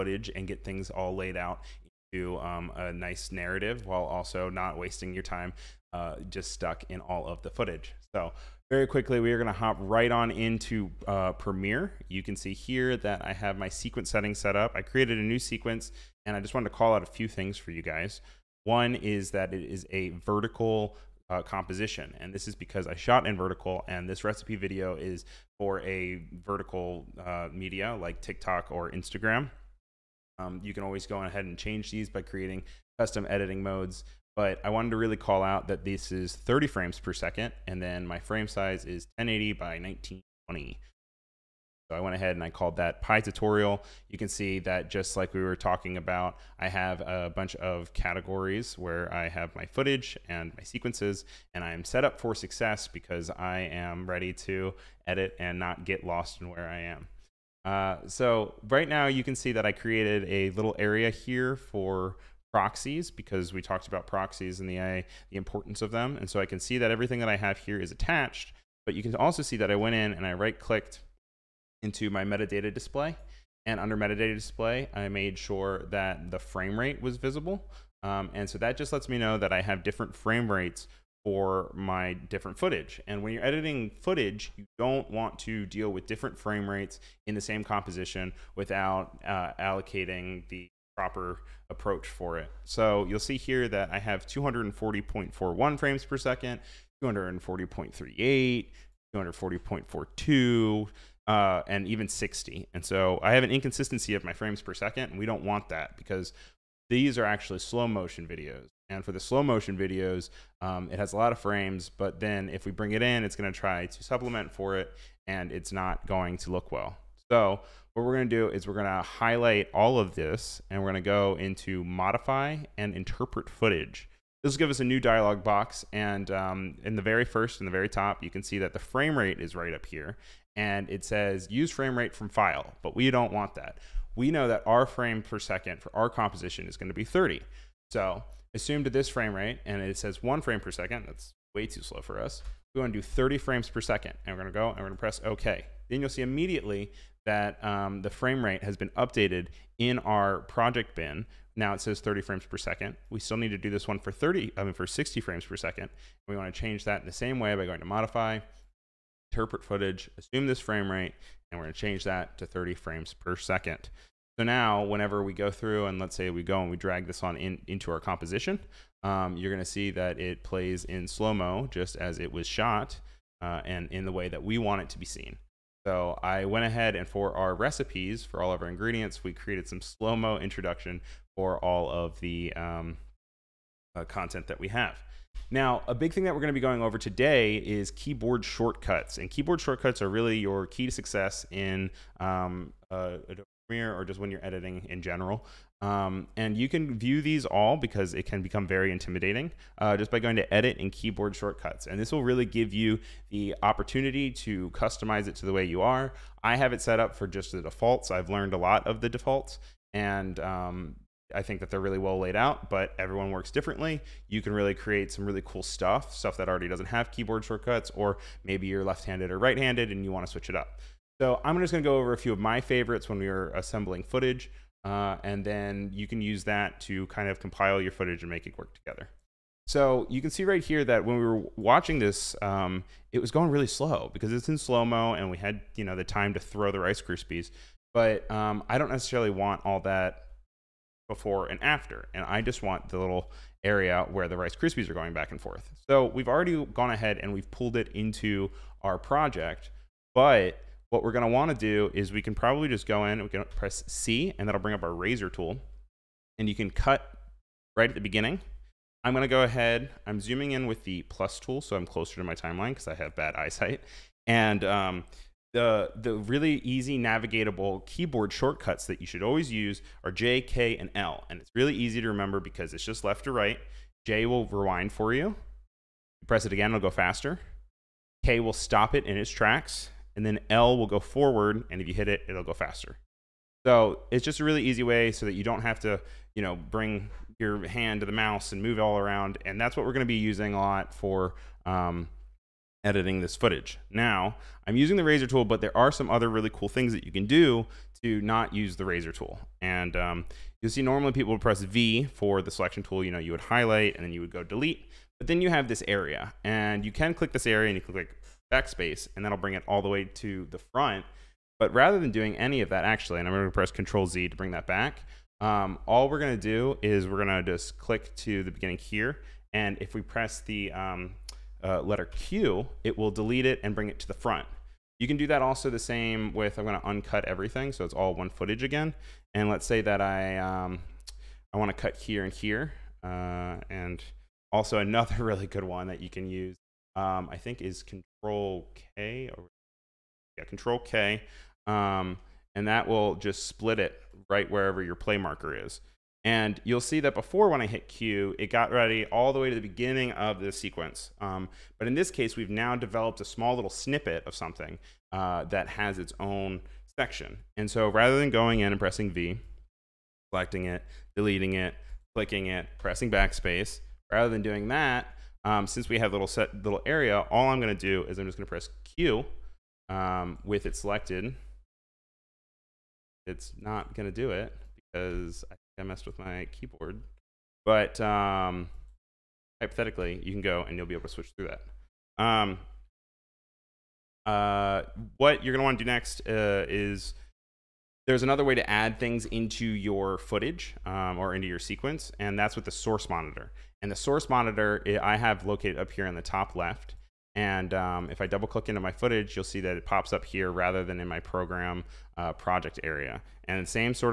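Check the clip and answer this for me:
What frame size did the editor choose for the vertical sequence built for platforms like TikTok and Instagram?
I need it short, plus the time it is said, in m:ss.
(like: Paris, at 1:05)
1080 by 1920, at 0:39.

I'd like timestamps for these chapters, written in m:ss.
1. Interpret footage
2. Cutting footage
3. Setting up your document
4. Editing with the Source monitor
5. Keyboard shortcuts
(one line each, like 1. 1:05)
1. 1:57
2. 3:48
3. 0:08
4. 6:23
5. 3:15.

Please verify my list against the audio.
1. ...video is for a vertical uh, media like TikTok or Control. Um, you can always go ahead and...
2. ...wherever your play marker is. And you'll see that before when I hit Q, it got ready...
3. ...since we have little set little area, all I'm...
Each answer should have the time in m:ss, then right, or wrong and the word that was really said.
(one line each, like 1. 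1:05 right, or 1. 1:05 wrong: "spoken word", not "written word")
1. 0:24 wrong: "Instagram", not "Control"
2. 5:44 right
3. 6:05 right.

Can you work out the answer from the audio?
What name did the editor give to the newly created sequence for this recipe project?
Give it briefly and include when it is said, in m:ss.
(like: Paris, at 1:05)
Pi tutorial, at 0:43.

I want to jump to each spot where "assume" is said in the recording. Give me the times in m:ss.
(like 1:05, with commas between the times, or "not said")
2:18, 2:40.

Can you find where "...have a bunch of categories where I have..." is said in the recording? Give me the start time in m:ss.
0:46.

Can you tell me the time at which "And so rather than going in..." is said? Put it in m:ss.
5:57.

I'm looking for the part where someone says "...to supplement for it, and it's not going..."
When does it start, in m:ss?
1:53.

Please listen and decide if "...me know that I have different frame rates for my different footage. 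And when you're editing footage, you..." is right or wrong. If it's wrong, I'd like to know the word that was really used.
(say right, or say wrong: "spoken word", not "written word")
right.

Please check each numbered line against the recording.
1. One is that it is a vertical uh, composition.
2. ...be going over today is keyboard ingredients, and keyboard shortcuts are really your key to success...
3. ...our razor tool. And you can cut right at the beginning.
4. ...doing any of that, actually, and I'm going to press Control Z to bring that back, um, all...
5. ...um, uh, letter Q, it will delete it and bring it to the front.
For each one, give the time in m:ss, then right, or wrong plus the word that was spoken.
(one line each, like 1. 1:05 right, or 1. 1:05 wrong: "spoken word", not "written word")
1. 0:18 right
2. 3:06 wrong: "shortcuts", not "ingredients"
3. 4:14 right
4. 5:12 right
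5. 5:20 right.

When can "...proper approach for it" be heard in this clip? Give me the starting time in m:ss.
1:31.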